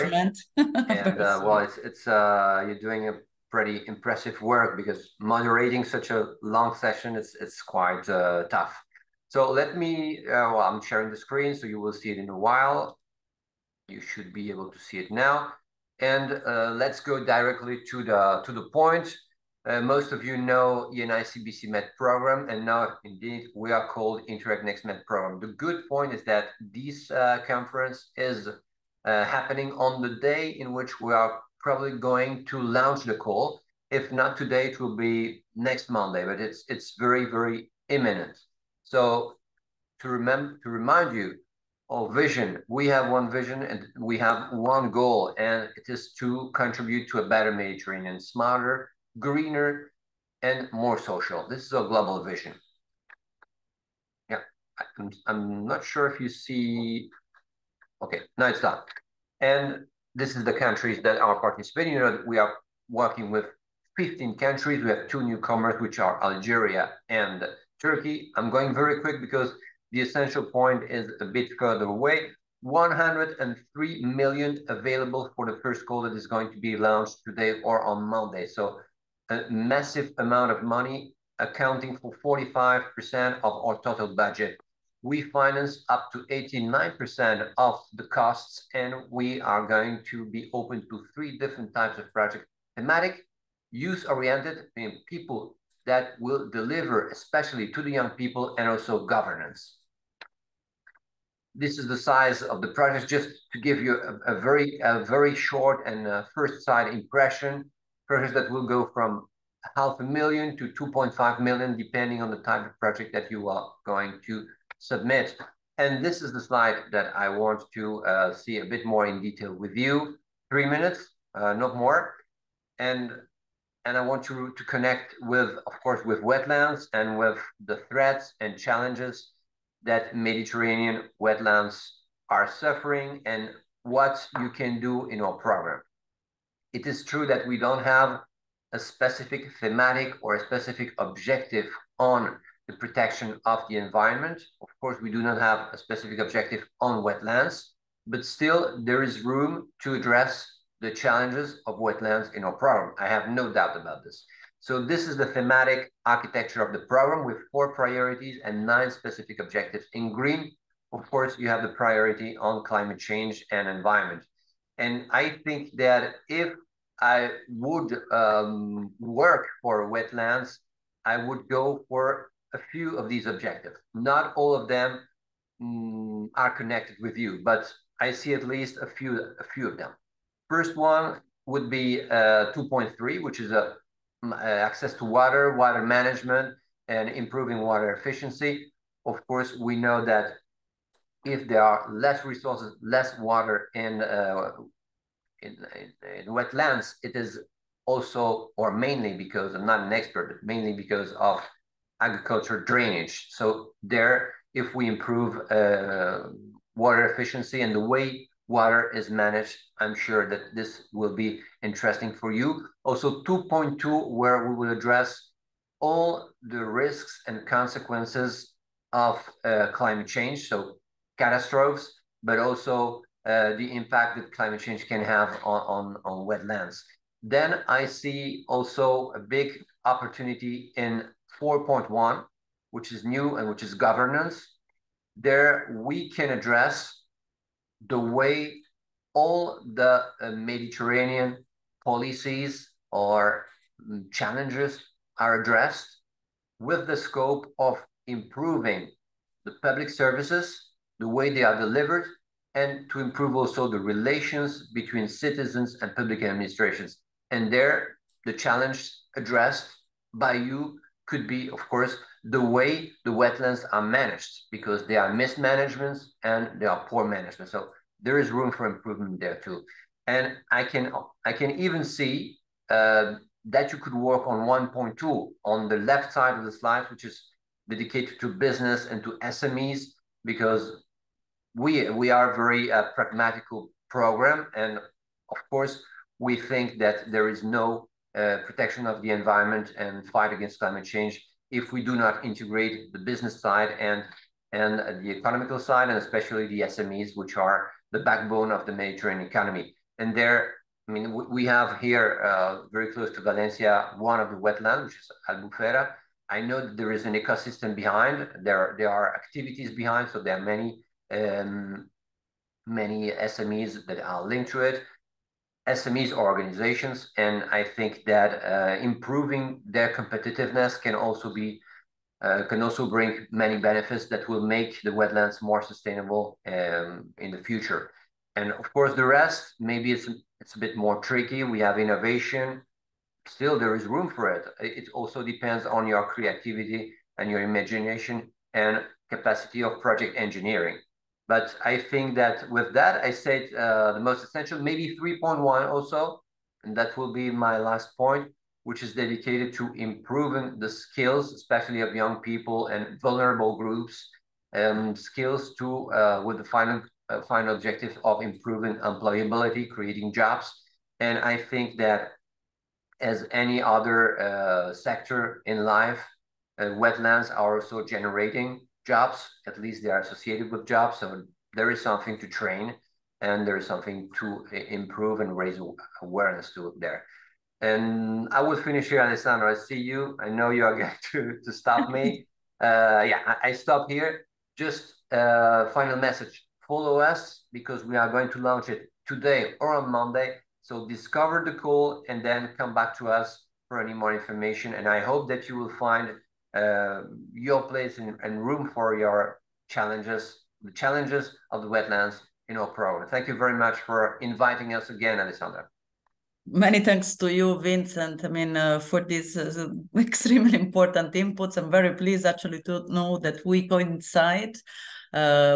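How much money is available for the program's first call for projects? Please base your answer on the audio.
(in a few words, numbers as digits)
103 million.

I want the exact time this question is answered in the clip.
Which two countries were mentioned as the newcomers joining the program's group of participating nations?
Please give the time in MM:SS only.
01:06.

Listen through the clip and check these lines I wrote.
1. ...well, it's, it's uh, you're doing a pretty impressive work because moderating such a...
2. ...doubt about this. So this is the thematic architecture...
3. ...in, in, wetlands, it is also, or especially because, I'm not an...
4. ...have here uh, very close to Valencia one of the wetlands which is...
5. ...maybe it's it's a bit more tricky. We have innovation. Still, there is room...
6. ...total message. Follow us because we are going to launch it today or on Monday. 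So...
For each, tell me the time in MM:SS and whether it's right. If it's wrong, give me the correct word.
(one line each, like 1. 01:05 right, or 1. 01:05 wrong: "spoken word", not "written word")
1. 00:01 right
2. 02:33 right
3. 03:15 wrong: "mainly", not "especially"
4. 05:01 right
5. 05:29 right
6. 06:25 wrong: "final", not "total".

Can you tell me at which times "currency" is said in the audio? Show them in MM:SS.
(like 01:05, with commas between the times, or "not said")
not said.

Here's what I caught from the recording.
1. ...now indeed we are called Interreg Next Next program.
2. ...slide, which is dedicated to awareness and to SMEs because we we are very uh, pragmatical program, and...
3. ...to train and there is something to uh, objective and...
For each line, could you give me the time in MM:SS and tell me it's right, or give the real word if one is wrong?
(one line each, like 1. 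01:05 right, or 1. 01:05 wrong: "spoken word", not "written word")
1. 00:22 wrong: "Med", not "Next"
2. 04:36 wrong: "business", not "awareness"
3. 06:12 wrong: "improve", not "objective".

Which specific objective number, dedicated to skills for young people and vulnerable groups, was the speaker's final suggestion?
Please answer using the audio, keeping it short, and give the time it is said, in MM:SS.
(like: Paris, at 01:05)
3.1, at 05:45.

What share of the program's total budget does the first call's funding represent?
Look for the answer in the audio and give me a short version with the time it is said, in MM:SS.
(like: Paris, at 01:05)
45%, at 01:22.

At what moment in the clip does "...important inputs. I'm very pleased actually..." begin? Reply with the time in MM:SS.
06:50.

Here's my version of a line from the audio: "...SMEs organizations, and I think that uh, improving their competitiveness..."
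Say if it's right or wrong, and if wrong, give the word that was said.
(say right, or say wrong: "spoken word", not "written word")
right.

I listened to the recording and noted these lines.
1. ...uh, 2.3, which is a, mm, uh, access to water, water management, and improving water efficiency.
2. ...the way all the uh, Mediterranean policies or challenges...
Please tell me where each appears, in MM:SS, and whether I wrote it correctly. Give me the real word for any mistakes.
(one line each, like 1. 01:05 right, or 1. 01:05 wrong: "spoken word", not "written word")
1. 03:02 right
2. 03:57 right.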